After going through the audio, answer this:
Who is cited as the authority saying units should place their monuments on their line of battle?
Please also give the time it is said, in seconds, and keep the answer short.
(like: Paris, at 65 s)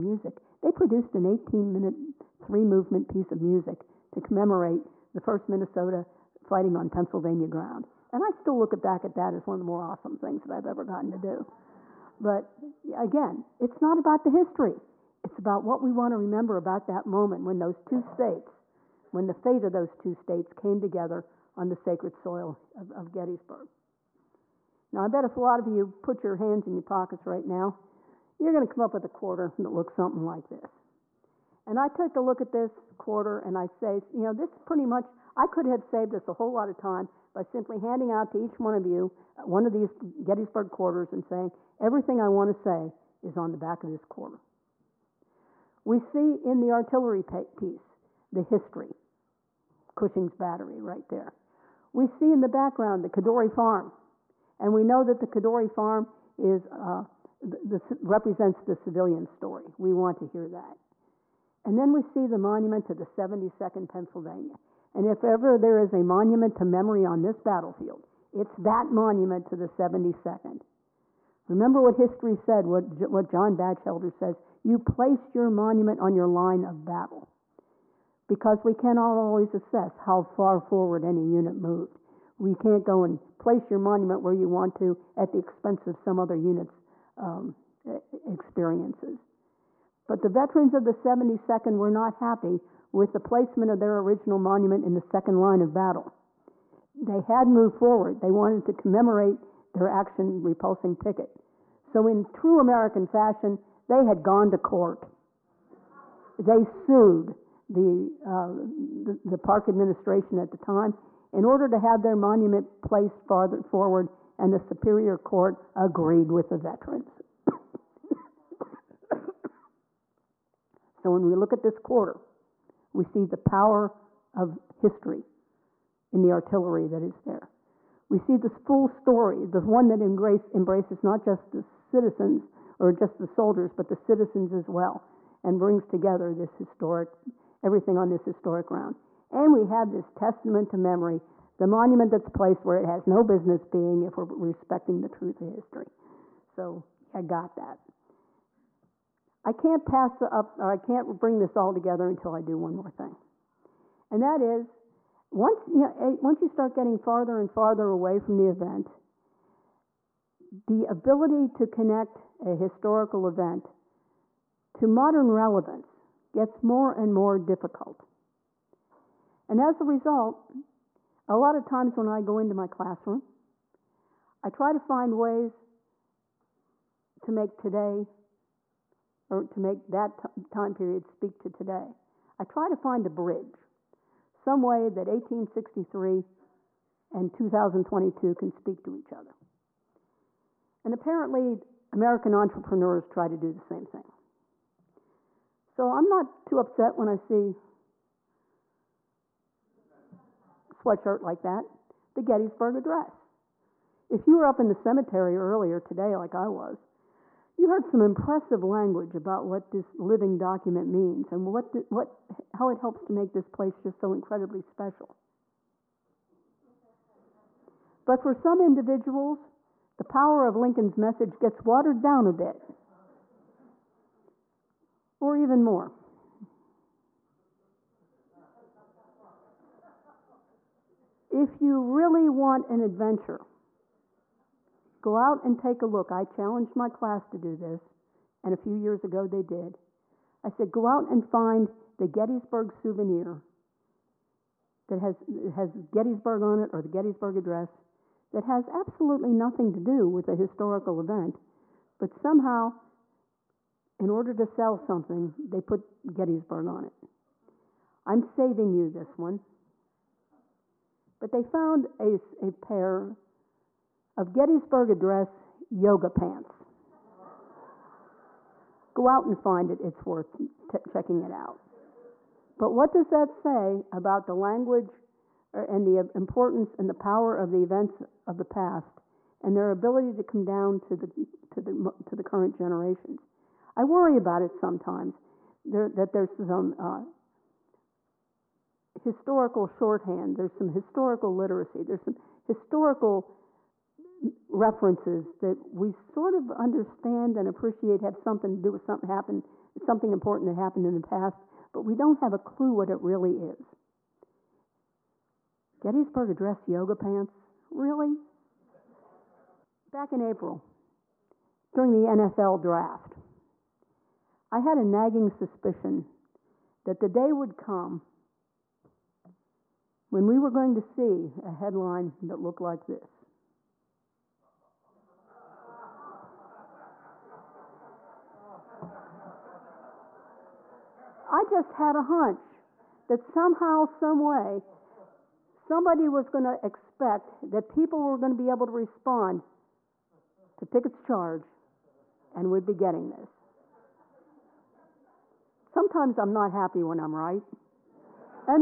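John Bachelder, at 73 s.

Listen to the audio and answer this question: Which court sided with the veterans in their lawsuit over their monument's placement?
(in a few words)
Superior Court.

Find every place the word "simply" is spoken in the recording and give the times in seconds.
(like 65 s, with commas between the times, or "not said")
37 s.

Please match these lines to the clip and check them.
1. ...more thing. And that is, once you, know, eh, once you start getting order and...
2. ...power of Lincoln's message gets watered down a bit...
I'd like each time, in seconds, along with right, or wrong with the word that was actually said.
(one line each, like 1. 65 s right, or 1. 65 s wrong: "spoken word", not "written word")
1. 152 s wrong: "farther", not "order"
2. 220 s right.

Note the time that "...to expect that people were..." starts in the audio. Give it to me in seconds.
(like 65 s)
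336 s.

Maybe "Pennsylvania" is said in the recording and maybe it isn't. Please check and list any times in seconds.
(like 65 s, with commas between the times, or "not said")
6 s, 63 s.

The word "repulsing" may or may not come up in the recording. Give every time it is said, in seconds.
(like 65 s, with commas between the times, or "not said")
100 s.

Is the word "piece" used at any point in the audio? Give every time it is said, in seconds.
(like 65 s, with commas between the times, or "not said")
3 s, 47 s.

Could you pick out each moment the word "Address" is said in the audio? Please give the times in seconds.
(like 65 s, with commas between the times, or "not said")
202 s, 247 s, 264 s, 306 s.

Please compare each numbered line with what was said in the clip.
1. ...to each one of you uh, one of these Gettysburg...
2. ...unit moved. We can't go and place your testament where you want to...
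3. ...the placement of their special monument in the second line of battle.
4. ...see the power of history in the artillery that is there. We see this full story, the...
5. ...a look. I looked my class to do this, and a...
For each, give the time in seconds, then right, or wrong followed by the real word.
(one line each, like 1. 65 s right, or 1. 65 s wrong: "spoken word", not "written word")
1. 38 s right
2. 81 s wrong: "monument", not "testament"
3. 93 s wrong: "original", not "special"
4. 123 s right
5. 235 s wrong: "challenged", not "looked".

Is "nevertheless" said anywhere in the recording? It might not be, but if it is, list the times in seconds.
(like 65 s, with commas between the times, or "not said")
not said.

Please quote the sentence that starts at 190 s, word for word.
And apparently, American entrepreneurs try to do the same thing.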